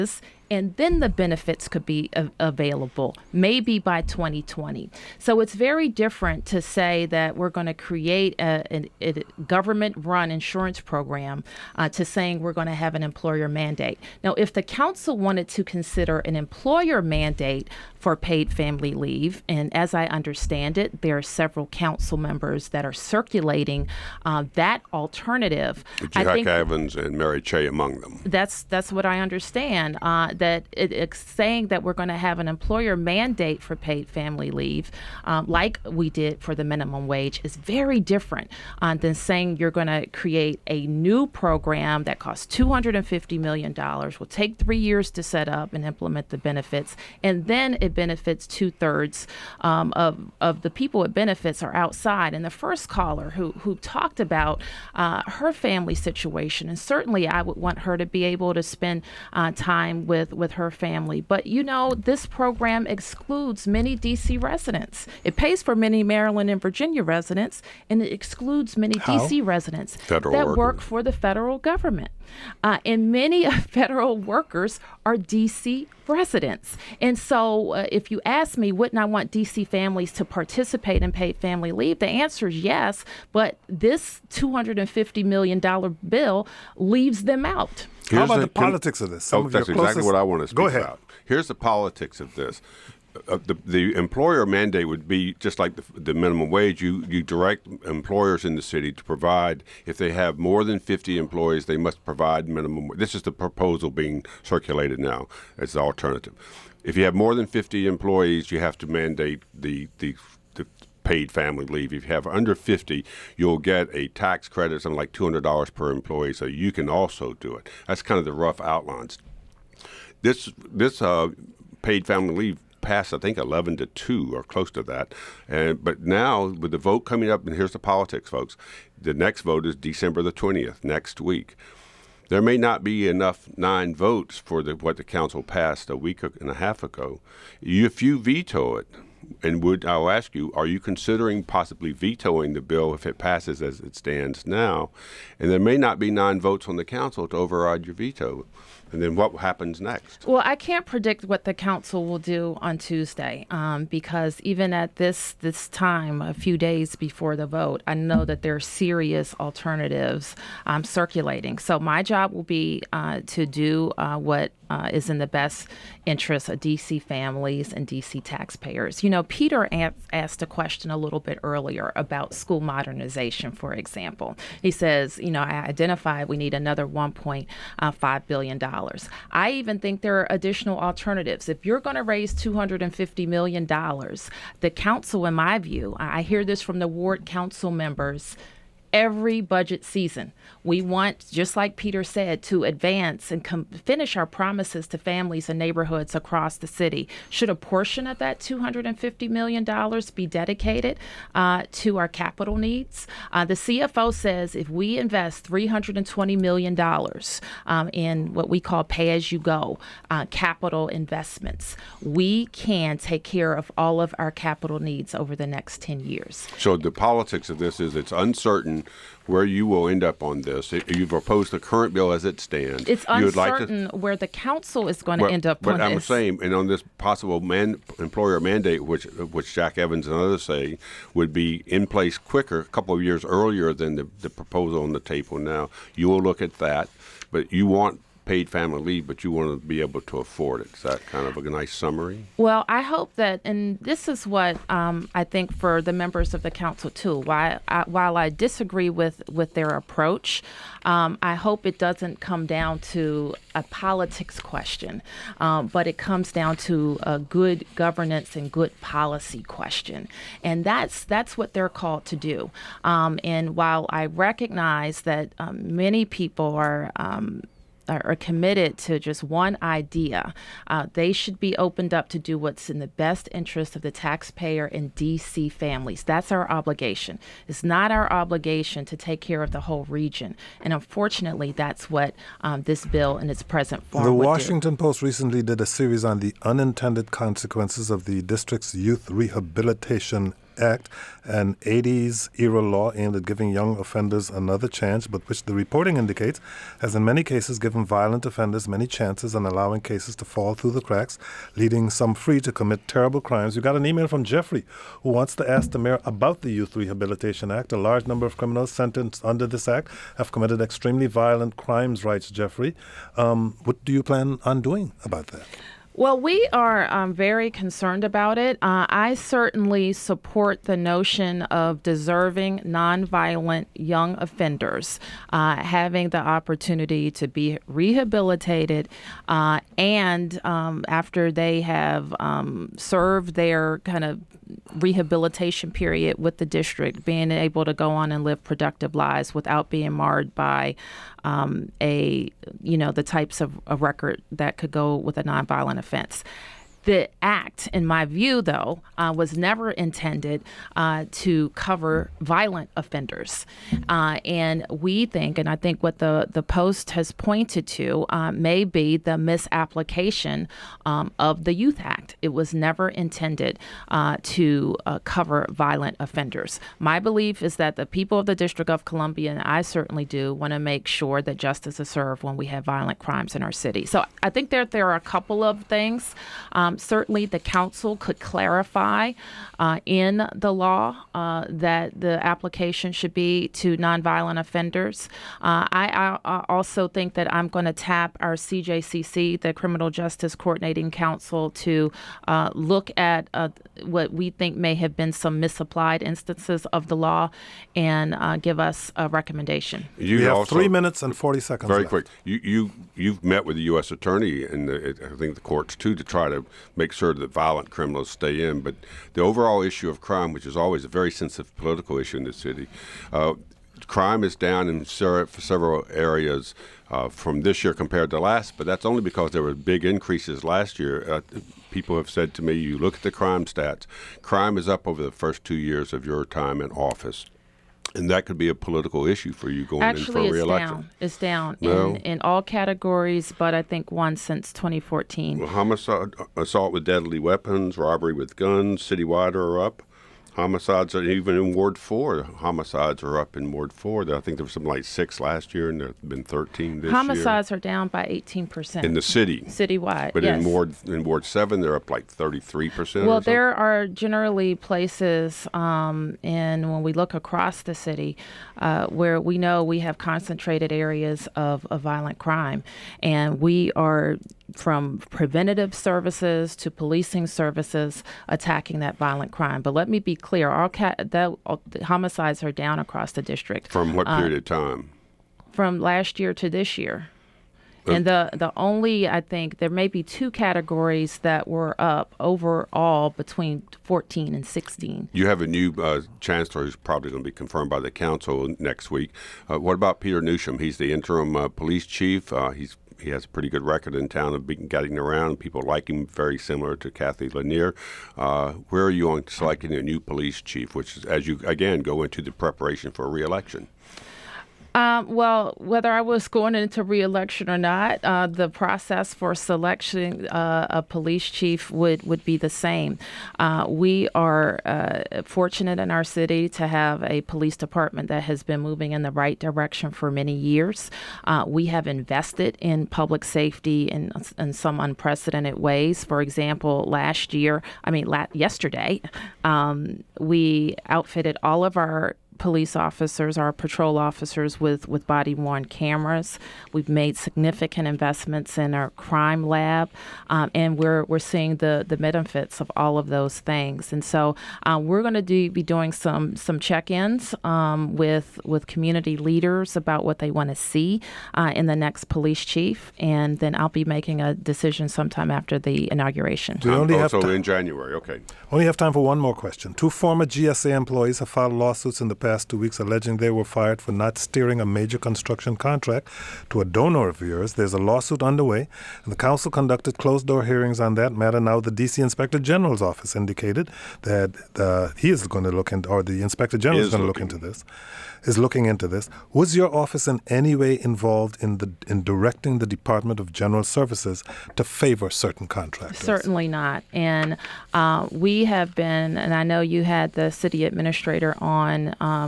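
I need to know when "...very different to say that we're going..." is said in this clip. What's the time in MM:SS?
00:05.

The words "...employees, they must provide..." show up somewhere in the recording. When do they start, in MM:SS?
01:41.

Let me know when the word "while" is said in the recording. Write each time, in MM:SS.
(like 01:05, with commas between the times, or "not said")
04:07, 04:23.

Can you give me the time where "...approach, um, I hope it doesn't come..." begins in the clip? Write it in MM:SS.
04:09.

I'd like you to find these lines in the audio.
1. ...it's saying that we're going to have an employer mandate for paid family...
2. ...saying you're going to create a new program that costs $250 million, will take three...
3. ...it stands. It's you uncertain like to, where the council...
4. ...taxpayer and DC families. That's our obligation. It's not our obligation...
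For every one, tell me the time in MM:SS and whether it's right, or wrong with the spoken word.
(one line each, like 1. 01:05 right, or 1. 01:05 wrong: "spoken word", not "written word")
1. 00:30 right
2. 00:39 right
3. 03:42 right
4. 04:33 right.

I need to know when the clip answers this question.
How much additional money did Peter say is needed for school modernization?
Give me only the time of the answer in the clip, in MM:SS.
02:56.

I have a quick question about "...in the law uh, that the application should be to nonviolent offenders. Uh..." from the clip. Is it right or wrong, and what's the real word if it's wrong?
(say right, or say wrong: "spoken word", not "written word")
right.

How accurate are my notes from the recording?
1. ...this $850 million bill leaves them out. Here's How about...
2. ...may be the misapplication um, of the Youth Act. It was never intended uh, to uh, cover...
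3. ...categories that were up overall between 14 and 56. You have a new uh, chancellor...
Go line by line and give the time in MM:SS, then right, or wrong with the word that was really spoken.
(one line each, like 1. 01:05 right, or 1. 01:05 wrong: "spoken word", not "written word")
1. 01:23 wrong: "250", not "850"
2. 05:58 right
3. 08:00 wrong: "16", not "56".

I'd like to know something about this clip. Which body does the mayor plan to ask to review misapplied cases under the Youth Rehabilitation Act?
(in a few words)
Criminal Justice Coordinating Council.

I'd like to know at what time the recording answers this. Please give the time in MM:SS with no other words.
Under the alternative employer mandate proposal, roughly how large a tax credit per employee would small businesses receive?
01:55.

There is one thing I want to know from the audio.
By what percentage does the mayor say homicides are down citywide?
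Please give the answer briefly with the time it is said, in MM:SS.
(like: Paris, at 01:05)
18%, at 07:28.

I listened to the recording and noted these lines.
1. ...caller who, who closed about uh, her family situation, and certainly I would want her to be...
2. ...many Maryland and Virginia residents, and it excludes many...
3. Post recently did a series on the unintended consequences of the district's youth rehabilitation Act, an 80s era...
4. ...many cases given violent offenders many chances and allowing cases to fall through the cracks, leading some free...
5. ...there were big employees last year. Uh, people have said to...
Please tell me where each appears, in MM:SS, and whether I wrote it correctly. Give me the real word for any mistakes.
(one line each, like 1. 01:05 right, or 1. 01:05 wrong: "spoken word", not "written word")
1. 00:52 wrong: "talked", not "closed"
2. 01:05 right
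3. 04:44 right
4. 04:57 right
5. 06:59 wrong: "increases", not "employees".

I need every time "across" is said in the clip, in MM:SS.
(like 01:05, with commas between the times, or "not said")
03:16, 07:37, 07:52.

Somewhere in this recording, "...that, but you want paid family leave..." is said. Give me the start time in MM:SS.
03:56.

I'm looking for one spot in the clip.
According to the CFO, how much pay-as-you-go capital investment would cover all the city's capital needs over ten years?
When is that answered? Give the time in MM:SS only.
03:25.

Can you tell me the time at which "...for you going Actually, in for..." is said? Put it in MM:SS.
07:09.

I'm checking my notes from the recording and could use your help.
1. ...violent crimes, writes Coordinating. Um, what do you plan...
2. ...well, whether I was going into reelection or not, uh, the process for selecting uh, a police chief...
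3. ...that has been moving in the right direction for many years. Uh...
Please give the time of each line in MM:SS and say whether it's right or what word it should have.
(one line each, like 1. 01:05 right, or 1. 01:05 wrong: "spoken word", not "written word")
1. 05:11 wrong: "Jeffrey", not "Coordinating"
2. 08:25 right
3. 08:38 right.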